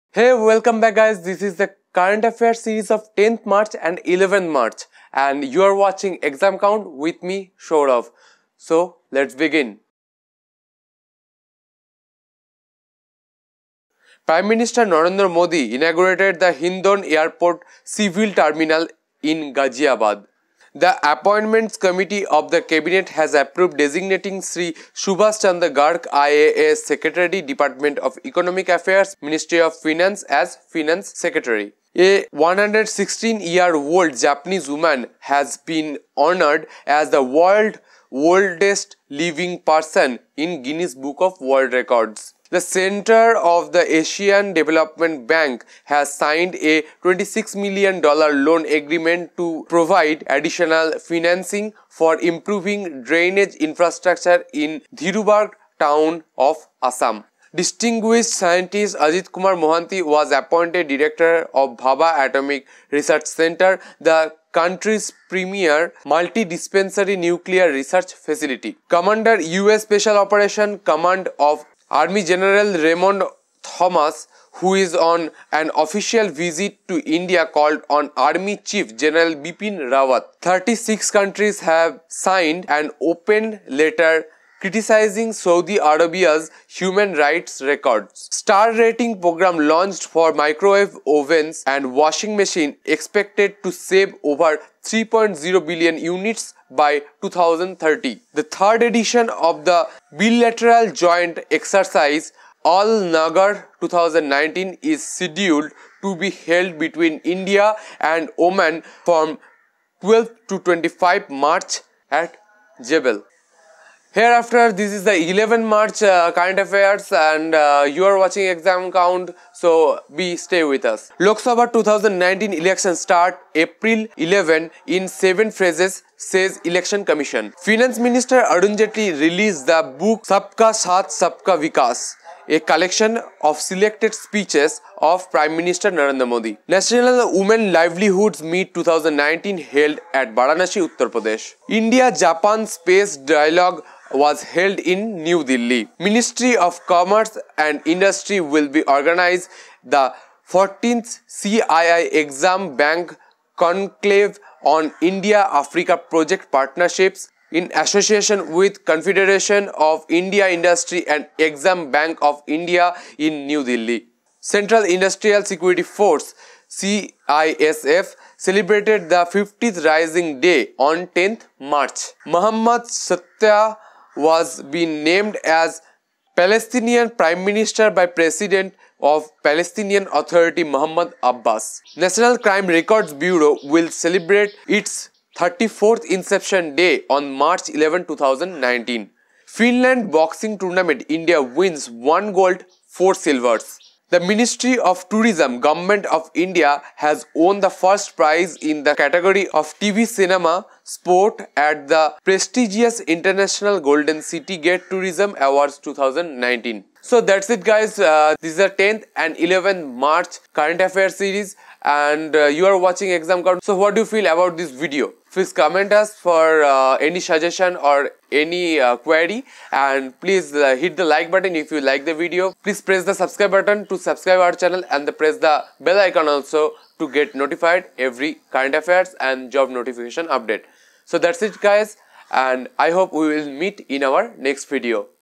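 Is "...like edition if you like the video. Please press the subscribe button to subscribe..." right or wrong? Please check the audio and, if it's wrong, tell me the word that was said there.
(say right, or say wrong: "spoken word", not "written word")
wrong: "button", not "edition".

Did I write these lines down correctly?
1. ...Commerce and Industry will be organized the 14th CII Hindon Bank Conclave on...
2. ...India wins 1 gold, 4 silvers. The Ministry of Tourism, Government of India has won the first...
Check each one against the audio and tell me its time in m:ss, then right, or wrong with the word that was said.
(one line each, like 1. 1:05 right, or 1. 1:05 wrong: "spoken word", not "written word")
1. 2:26 wrong: "EXIM", not "Hindon"
2. 3:11 right.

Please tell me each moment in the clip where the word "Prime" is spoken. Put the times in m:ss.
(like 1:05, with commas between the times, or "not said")
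0:14, 2:15, 2:57.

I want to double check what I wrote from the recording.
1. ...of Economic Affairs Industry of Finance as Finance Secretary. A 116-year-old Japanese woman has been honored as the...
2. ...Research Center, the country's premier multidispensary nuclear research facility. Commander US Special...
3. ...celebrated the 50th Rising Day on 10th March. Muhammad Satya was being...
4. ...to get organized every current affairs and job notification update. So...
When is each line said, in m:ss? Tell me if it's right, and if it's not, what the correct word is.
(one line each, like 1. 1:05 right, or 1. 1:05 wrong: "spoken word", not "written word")
1. 0:27 wrong: "Ministry", not "Industry"
2. 1:02 right
3. 2:48 right
4. 3:46 wrong: "notified", not "organized".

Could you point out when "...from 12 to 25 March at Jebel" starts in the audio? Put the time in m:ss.
1:49.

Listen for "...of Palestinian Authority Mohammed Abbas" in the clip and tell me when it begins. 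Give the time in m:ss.
2:59.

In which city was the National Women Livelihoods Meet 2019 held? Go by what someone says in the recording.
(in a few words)
Varanasi.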